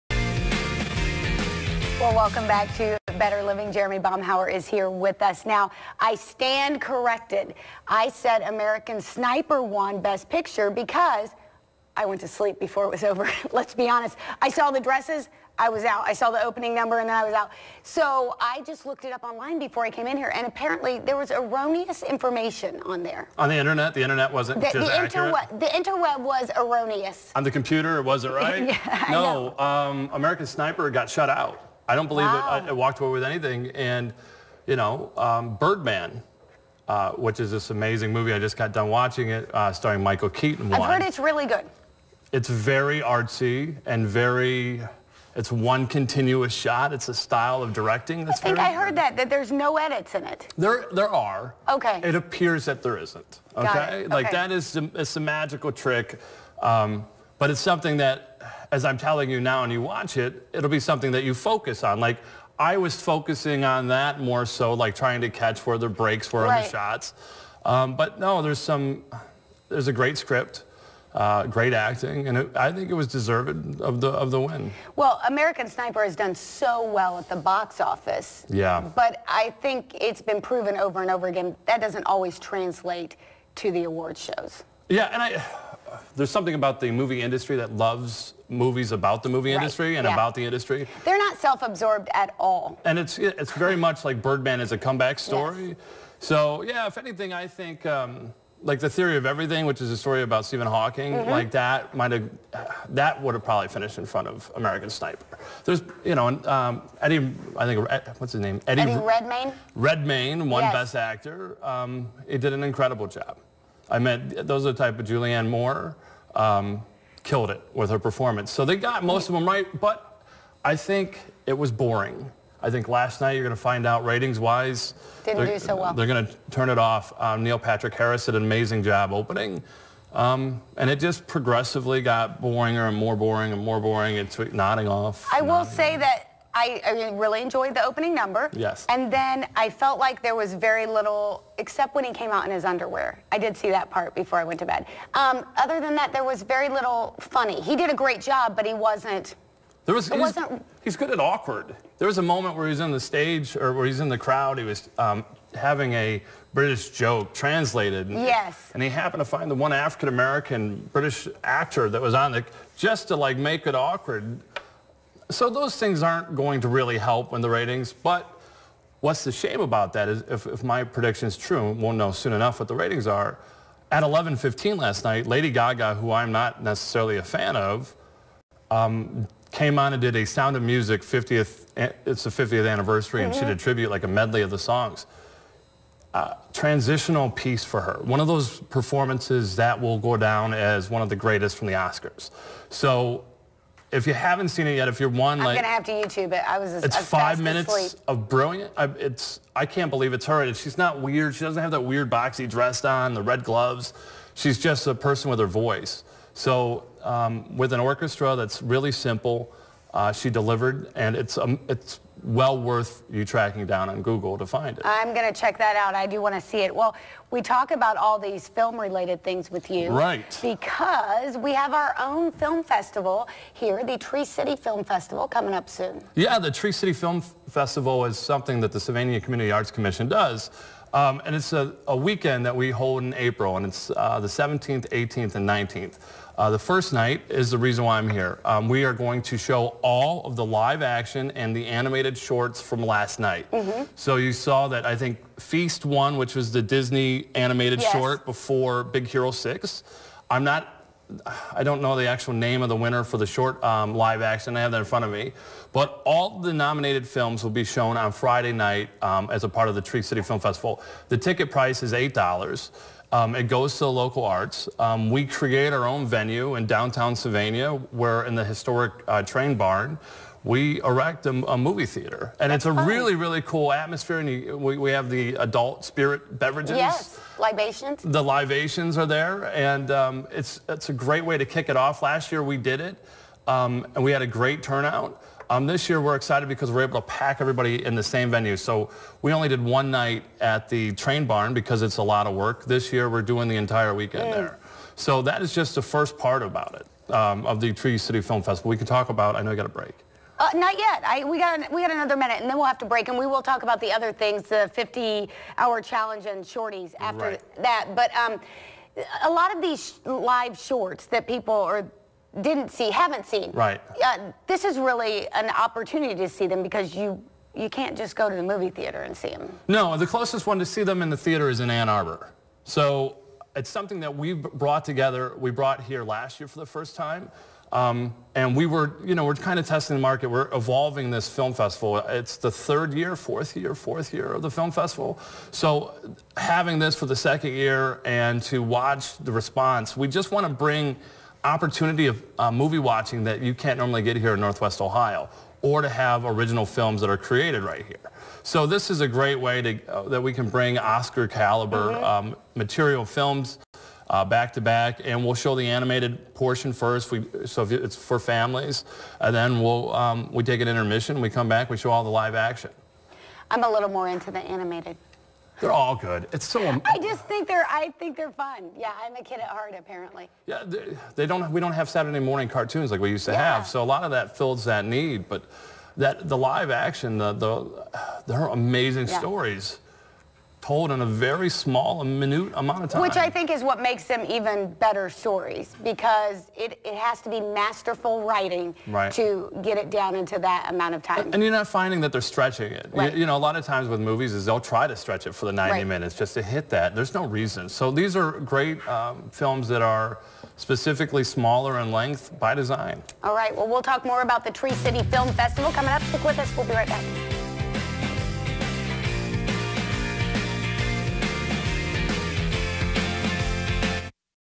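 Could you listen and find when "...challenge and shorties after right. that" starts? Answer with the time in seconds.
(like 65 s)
305 s.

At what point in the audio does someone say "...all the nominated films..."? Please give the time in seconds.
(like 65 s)
256 s.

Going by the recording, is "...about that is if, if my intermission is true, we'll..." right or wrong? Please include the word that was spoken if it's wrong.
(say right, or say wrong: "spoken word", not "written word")
wrong: "prediction", not "intermission".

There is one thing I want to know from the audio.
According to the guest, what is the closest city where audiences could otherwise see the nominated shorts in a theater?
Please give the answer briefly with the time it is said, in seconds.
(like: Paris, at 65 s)
Ann Arbor, at 321 s.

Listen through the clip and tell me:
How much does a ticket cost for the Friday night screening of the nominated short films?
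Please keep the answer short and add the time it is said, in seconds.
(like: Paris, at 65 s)
$8, at 261 s.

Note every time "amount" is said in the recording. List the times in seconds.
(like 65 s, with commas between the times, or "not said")
382 s, 390 s.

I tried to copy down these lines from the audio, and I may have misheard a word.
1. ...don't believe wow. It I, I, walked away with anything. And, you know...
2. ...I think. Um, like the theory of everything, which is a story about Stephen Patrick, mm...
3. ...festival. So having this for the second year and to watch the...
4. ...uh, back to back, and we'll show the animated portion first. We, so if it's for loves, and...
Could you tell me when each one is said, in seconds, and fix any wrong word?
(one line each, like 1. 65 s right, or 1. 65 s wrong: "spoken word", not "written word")
1. 31 s right
2. 97 s wrong: "Hawking", not "Patrick"
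3. 334 s right
4. 354 s wrong: "families", not "loves".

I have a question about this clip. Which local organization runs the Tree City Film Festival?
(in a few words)
Sylvania Community Arts Commission.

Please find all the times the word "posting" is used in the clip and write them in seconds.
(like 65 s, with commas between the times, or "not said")
not said.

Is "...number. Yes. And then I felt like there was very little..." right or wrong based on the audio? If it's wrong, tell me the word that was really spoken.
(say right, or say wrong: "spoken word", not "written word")
right.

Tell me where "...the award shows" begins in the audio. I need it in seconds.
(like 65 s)
83 s.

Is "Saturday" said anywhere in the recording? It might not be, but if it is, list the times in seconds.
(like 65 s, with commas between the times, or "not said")
371 s.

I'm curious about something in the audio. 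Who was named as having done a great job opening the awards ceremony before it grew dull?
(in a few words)
Neil Patrick Harris.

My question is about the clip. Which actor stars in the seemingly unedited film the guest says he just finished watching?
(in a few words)
Michael Keaton.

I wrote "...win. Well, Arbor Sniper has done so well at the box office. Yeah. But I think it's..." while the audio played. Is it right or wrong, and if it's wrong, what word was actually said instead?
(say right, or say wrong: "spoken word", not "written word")
wrong: "American", not "Arbor".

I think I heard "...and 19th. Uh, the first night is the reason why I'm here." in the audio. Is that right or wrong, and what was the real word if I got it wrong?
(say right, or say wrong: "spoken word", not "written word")
right.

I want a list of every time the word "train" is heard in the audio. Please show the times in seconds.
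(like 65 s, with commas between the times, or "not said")
269 s, 290 s.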